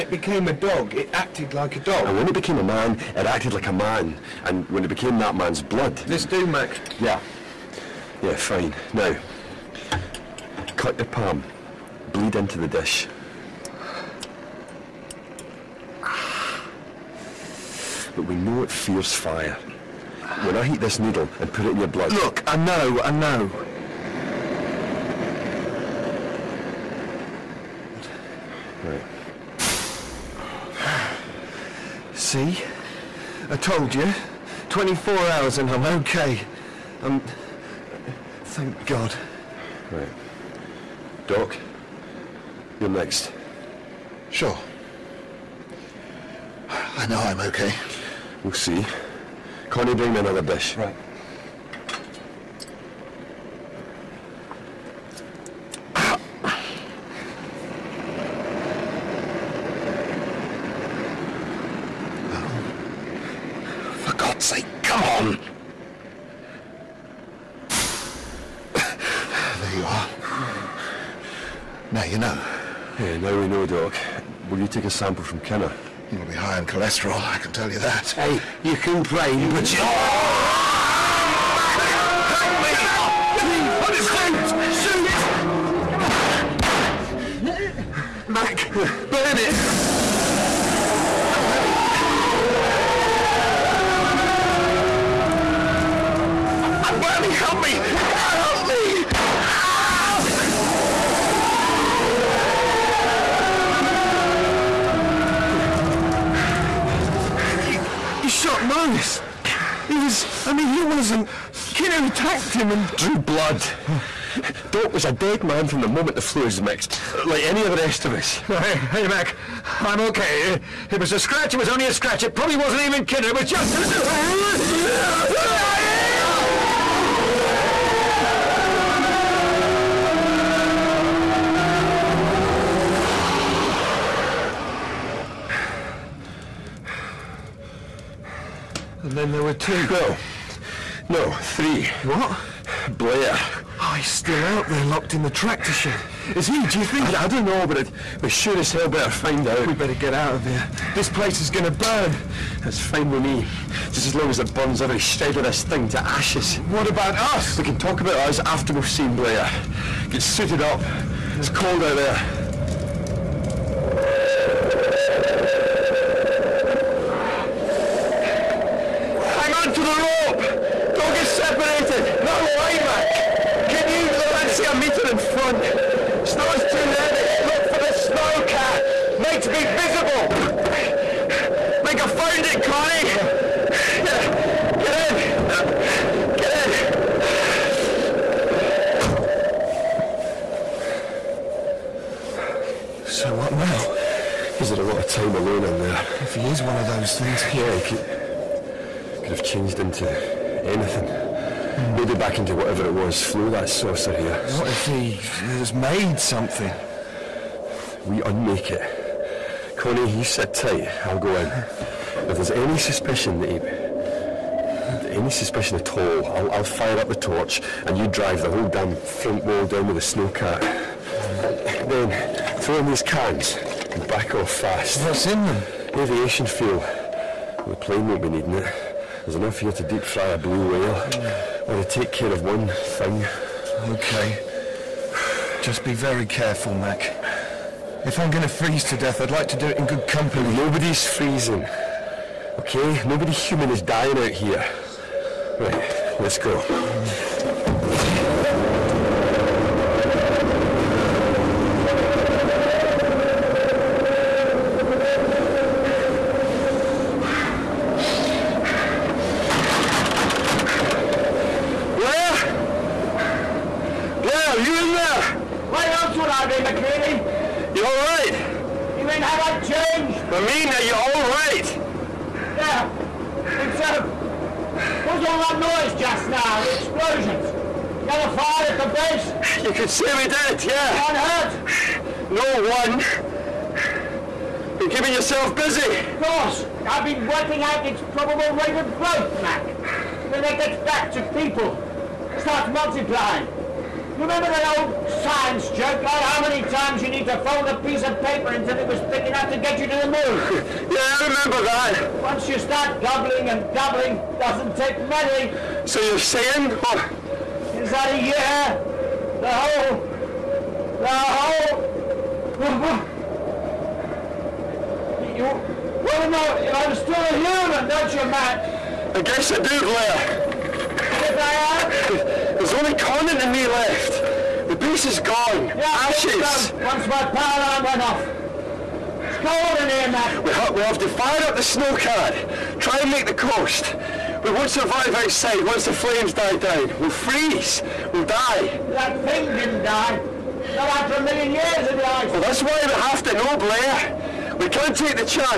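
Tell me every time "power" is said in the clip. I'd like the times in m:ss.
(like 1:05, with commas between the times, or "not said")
5:27.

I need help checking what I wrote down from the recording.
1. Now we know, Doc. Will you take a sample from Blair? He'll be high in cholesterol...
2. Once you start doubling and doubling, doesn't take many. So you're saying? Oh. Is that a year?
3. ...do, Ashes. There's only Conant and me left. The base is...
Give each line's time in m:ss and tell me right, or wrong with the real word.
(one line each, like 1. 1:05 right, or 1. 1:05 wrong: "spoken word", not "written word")
1. 1:13 wrong: "Kinner", not "Blair"
2. 5:02 right
3. 5:19 wrong: "Blair", not "Ashes".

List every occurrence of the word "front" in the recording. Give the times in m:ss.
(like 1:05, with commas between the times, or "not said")
2:55, 3:38.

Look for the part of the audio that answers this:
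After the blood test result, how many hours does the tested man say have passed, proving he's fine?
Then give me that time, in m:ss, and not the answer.
0:34.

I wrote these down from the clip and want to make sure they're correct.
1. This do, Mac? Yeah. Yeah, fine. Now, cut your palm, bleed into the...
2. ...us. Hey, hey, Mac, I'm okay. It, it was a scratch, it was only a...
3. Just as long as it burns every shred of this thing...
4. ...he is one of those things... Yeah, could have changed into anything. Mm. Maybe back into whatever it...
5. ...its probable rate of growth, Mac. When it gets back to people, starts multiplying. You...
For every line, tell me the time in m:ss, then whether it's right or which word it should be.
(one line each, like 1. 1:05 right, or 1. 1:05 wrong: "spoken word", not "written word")
1. 0:05 right
2. 1:58 right
3. 2:33 right
4. 3:16 right
5. 4:47 right.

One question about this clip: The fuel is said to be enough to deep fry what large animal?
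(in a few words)
blue whale.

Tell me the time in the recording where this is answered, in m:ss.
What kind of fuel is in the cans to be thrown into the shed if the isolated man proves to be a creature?
3:45.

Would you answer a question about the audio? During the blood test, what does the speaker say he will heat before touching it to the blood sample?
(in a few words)
needle.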